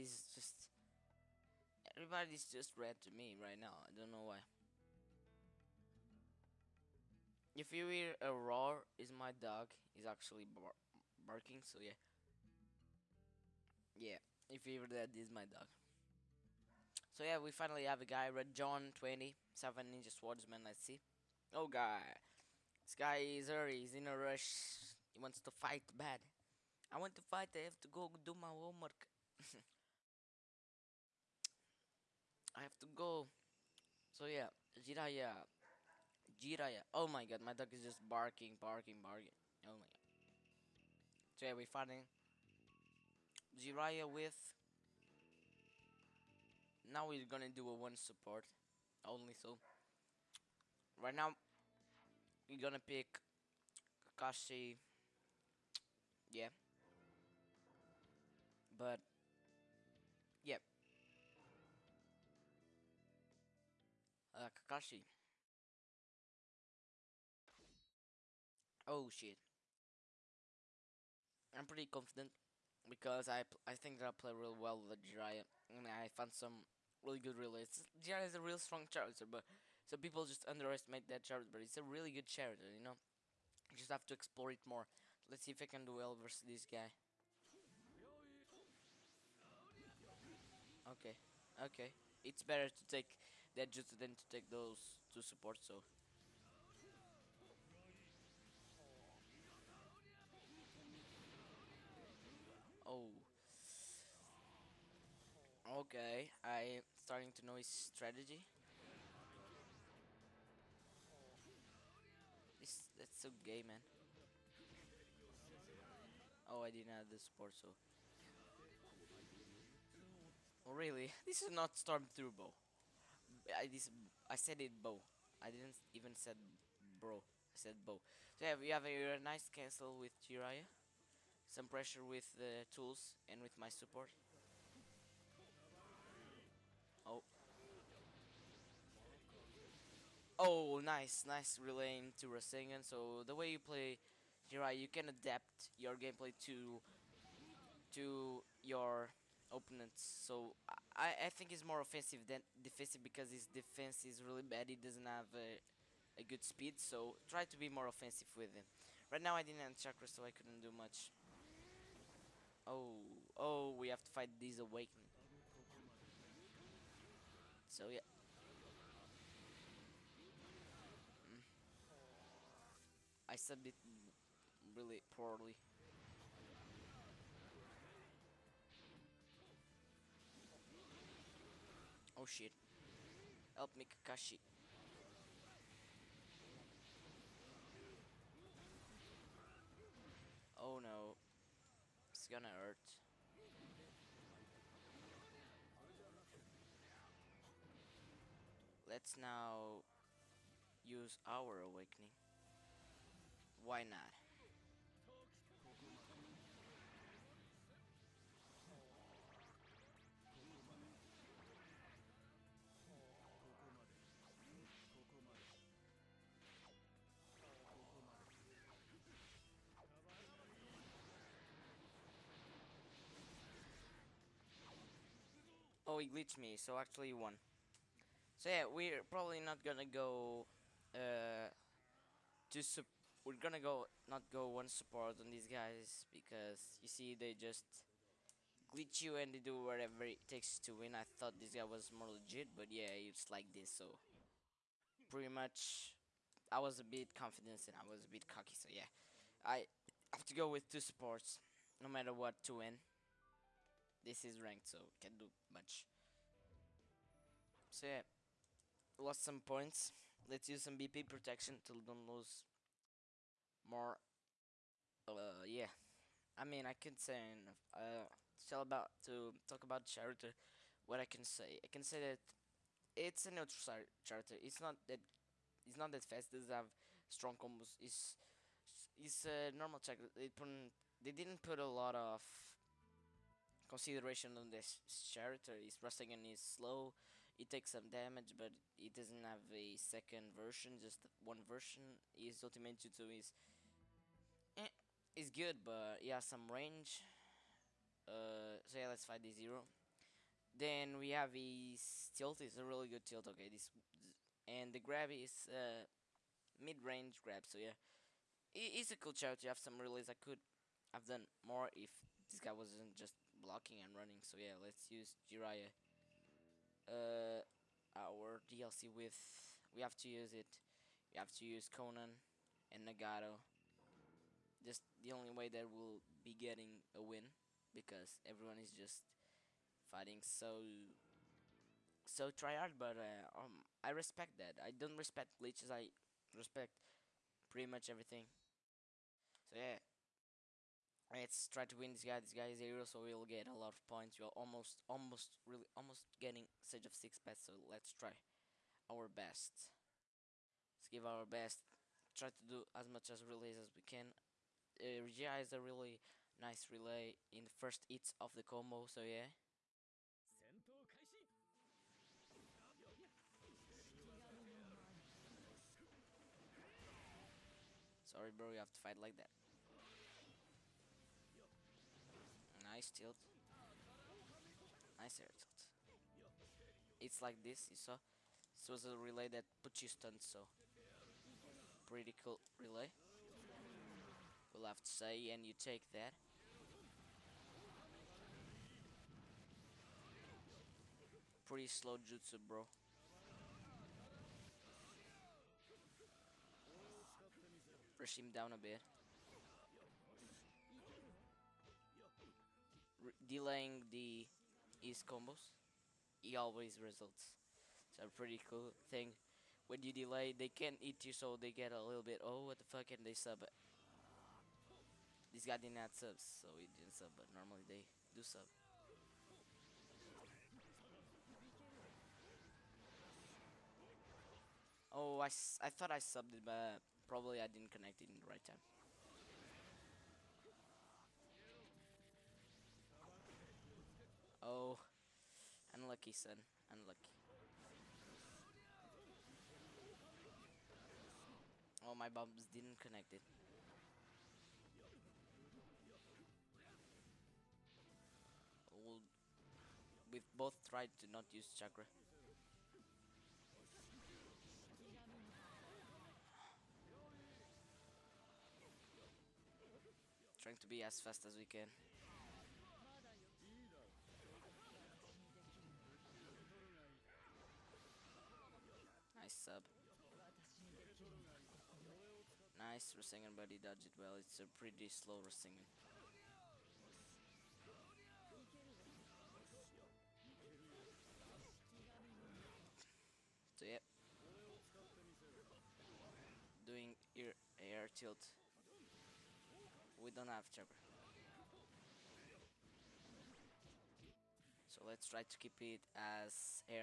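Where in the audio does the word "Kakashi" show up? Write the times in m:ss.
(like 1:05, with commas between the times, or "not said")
0:54, 1:04, 3:03.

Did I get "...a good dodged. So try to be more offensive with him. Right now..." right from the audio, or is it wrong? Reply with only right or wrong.
wrong.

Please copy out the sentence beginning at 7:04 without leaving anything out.
Oh, I, I thought I subbed it, but probably I didn't connect it in the right time.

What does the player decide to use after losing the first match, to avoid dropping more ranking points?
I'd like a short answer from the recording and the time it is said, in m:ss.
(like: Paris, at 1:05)
BP protection, at 4:20.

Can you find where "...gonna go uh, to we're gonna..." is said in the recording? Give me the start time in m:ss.
3:49.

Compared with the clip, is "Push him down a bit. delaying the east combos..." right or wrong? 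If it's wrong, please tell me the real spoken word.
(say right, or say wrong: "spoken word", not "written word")
right.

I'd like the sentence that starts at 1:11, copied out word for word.
I'm pretty confident because I I think that I play real well with Jiraiya and I found some really good realists.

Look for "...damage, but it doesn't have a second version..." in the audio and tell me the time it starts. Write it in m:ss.
4:47.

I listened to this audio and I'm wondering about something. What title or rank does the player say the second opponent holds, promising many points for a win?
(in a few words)
Hero.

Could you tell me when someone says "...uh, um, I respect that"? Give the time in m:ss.
5:32.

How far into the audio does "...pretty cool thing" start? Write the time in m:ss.
6:48.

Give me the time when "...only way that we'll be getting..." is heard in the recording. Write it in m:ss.
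5:25.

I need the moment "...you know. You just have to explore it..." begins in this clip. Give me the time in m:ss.
1:22.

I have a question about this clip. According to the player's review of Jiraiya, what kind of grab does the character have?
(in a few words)
Mid-range grab.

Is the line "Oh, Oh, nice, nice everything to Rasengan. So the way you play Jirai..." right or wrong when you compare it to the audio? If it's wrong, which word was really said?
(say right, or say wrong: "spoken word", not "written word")
wrong: "relaying", not "everything".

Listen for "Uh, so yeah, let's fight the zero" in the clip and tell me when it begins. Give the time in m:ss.
4:58.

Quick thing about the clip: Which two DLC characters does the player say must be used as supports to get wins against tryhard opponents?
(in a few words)
Konan and Nagato.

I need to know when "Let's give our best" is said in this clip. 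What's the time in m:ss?
5:50.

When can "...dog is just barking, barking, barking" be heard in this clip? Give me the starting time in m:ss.
0:37.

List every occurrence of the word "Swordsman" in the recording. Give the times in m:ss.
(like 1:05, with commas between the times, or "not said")
0:20.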